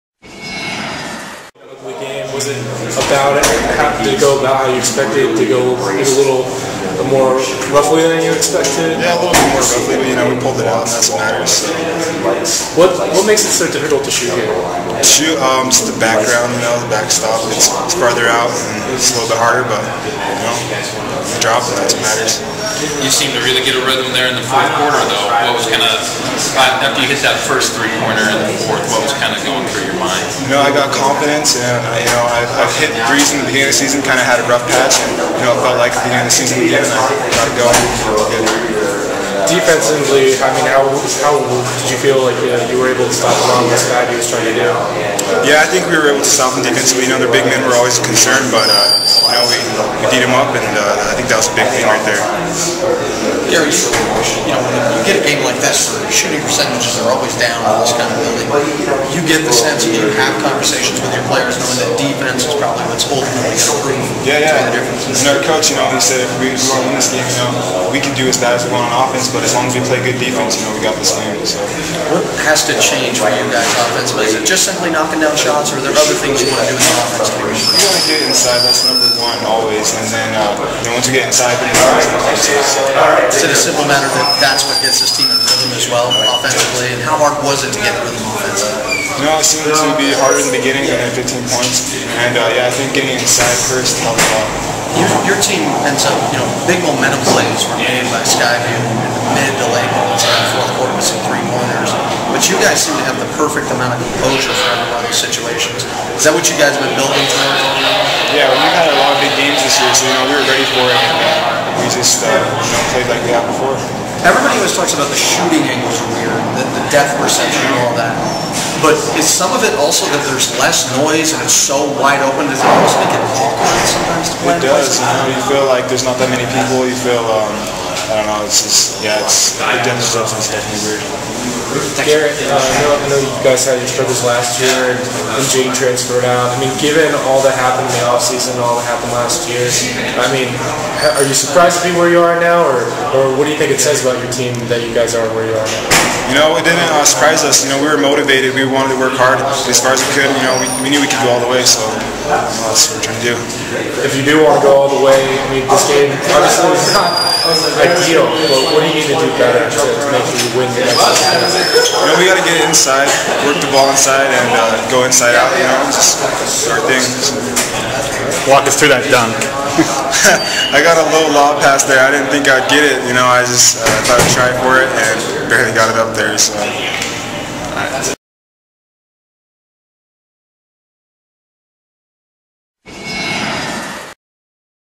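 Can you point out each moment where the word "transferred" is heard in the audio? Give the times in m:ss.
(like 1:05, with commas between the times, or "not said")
2:15.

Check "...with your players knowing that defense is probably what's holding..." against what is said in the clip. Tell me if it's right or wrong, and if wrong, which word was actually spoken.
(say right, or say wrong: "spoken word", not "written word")
right.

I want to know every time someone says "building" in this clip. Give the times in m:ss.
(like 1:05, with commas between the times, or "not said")
0:58, 1:46.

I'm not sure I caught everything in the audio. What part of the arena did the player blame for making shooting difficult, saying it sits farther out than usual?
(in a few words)
The backstop.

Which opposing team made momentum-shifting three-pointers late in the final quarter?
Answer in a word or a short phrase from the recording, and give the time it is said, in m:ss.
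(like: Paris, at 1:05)
Sky View, at 1:38.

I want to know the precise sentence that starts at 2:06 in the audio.
You feel um, I don't know.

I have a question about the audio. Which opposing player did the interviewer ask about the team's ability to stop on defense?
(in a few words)
Ron Lestat.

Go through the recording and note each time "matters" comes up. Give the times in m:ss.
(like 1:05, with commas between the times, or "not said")
0:11, 0:22, 1:23.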